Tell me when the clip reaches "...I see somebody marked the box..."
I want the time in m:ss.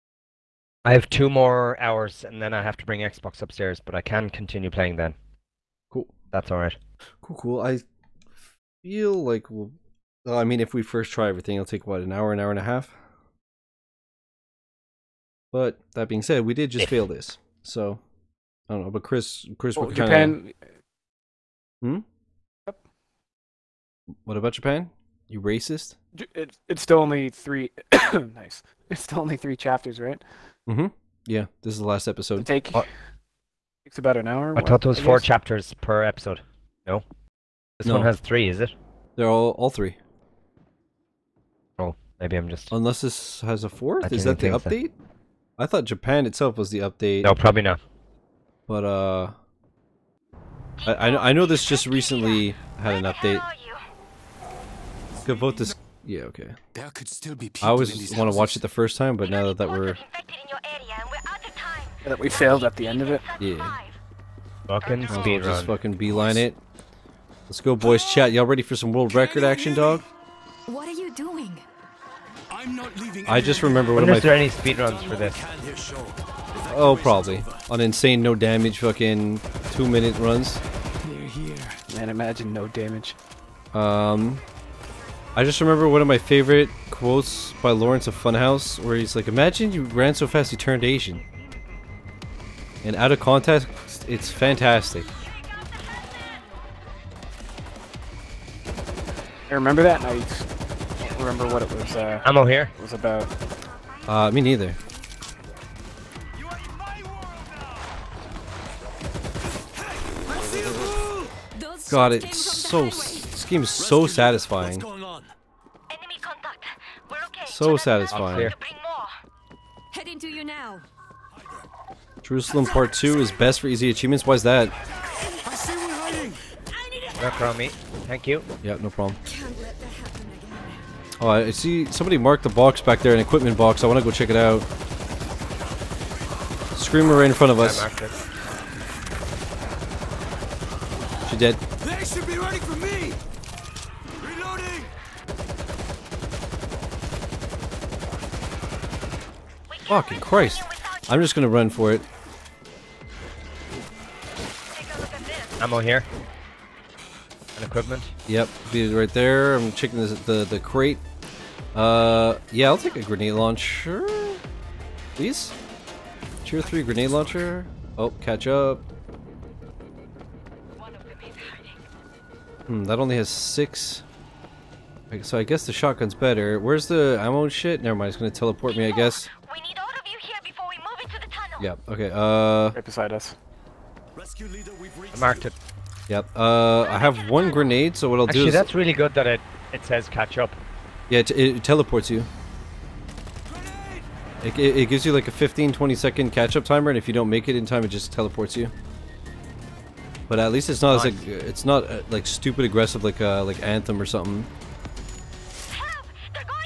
2:11.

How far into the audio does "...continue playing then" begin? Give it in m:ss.
0:04.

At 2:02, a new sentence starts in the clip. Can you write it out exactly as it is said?
Jerusalem Part 2 is best for easy achievements.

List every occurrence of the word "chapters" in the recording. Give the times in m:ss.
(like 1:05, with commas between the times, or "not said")
0:29, 0:35.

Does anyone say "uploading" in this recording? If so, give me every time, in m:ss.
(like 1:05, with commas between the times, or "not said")
not said.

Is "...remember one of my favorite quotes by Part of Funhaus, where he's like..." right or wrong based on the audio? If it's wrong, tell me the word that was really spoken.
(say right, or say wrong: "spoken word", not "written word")
wrong: "Lawrence", not "Part".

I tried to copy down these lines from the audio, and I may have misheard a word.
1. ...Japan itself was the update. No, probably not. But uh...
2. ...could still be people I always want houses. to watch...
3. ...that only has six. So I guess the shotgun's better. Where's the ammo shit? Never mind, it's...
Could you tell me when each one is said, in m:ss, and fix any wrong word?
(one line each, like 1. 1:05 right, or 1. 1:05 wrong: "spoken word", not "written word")
1. 0:45 right
2. 0:56 right
3. 2:52 right.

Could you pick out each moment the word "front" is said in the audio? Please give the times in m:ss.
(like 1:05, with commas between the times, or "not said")
2:17.